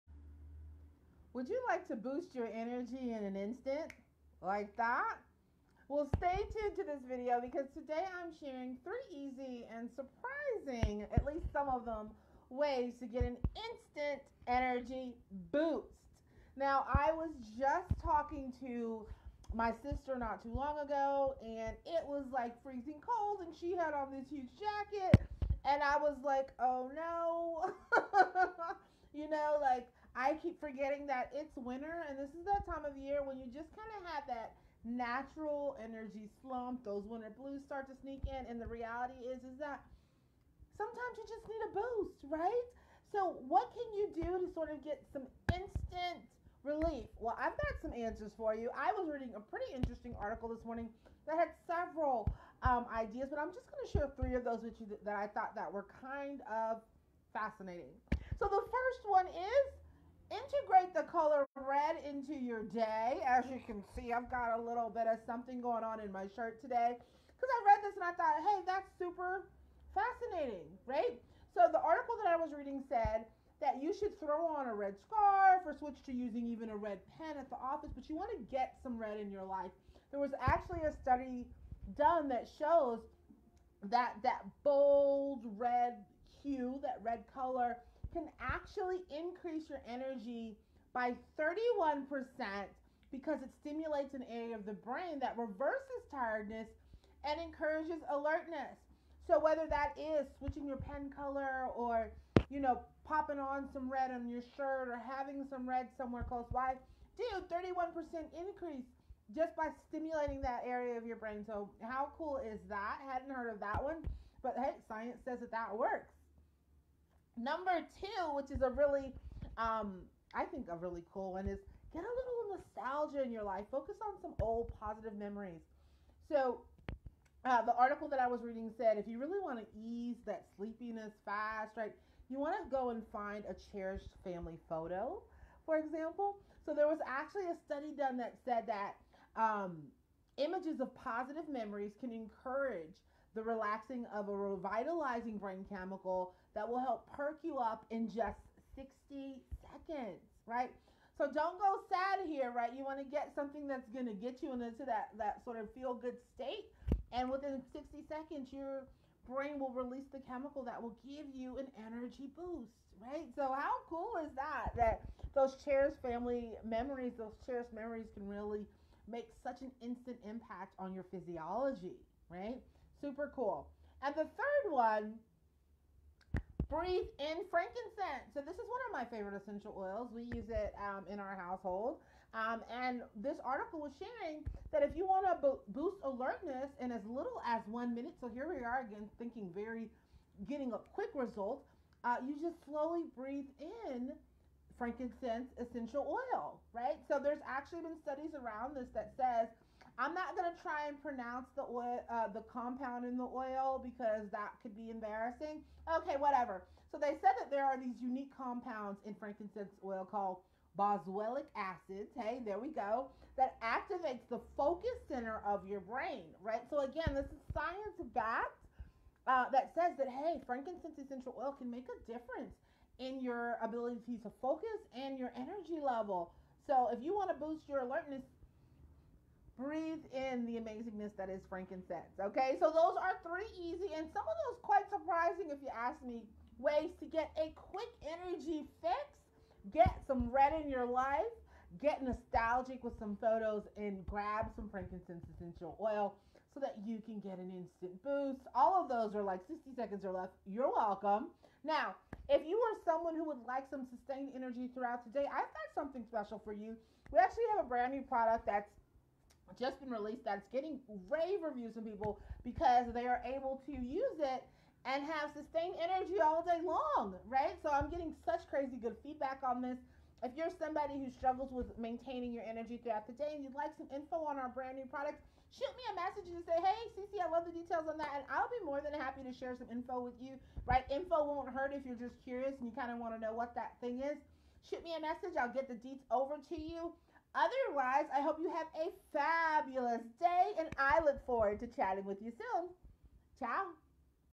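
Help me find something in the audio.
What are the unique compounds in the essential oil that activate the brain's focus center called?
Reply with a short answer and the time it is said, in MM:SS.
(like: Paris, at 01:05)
Boswellic acids, at 03:30.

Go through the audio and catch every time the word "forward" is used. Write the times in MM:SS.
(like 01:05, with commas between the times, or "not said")
04:51.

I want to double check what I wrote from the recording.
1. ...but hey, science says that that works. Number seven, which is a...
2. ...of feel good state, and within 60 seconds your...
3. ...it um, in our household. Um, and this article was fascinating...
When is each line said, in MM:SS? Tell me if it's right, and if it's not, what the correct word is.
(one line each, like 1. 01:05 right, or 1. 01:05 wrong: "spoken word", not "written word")
1. 01:54 wrong: "two", not "seven"
2. 02:35 right
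3. 03:00 wrong: "sharing", not "fascinating".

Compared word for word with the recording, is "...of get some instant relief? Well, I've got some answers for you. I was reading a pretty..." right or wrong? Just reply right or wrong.
right.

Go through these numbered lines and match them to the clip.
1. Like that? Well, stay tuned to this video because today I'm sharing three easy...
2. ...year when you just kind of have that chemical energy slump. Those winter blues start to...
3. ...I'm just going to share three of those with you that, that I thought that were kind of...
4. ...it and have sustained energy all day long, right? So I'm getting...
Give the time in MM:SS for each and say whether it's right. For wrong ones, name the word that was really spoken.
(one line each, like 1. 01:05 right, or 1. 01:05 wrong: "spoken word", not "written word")
1. 00:04 right
2. 00:32 wrong: "natural", not "chemical"
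3. 00:53 right
4. 04:24 right.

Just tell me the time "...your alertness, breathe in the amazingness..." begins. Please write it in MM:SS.
03:47.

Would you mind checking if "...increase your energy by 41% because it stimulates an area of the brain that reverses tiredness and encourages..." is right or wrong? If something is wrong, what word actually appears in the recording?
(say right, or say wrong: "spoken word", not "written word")
wrong: "31", not "41".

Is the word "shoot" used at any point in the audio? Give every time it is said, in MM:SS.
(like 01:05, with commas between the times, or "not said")
04:35, 04:44.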